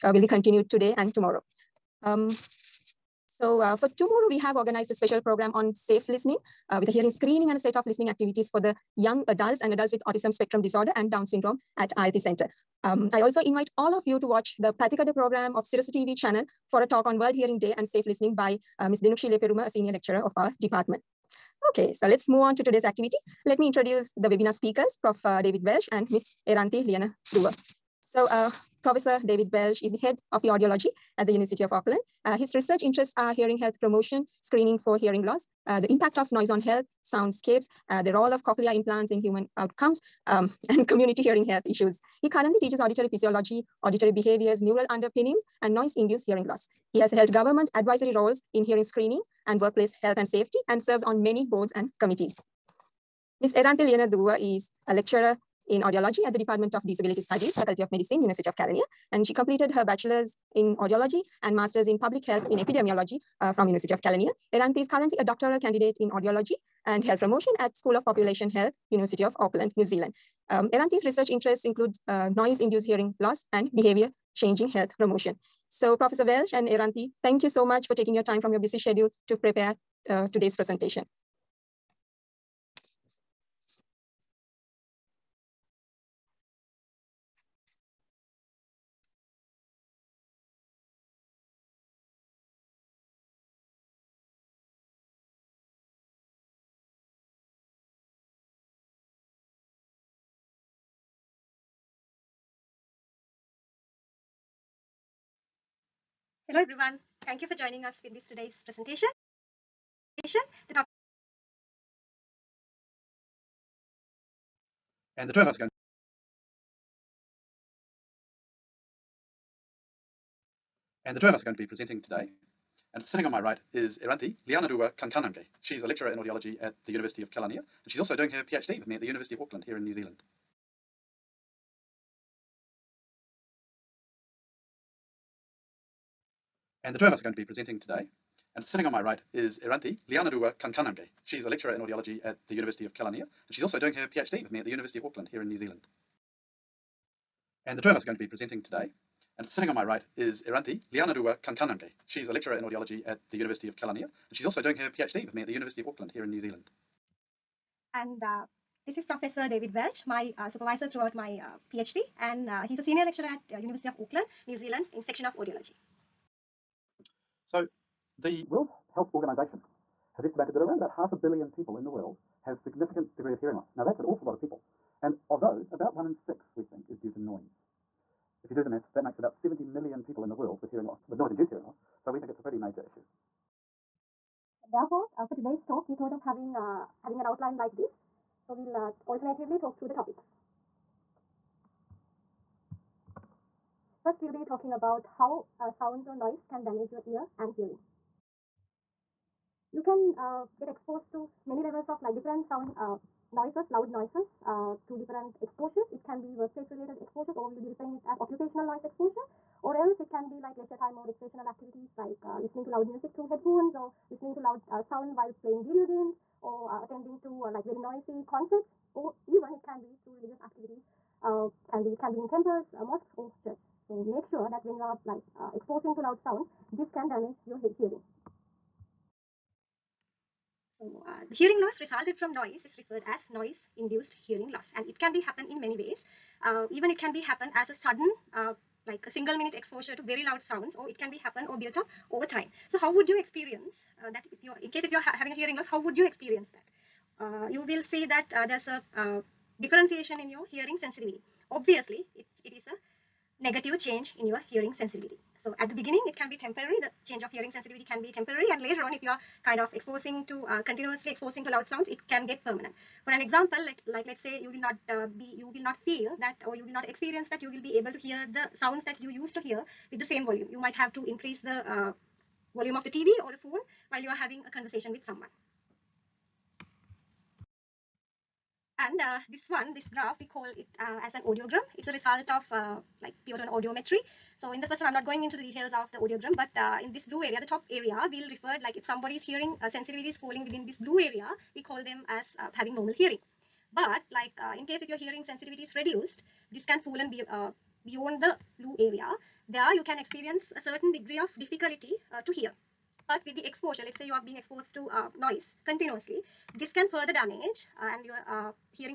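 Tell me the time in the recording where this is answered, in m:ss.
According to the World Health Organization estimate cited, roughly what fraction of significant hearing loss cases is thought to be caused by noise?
2:55.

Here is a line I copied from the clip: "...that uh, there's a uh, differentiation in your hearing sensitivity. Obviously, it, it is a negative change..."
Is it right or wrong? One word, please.
right.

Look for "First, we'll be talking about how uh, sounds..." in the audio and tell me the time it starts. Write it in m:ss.
3:14.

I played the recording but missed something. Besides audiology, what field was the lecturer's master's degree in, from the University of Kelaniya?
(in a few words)
public health in epidemiology.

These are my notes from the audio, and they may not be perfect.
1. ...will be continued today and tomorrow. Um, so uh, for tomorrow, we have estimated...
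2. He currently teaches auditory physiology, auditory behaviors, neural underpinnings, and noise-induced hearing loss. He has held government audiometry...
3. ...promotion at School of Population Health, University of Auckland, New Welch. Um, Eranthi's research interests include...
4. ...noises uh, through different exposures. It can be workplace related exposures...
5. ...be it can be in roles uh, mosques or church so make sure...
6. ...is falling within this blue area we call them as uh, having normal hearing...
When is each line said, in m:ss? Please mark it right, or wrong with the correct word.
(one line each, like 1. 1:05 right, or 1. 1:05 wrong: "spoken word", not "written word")
1. 0:00 wrong: "organized", not "estimated"
2. 0:42 wrong: "advisory", not "audiometry"
3. 1:07 wrong: "Zealand", not "Welch"
4. 3:23 right
5. 3:41 wrong: "temples", not "roles"
6. 4:50 right.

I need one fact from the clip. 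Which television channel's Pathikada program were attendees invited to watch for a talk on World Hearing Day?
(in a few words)
Sirasa TV.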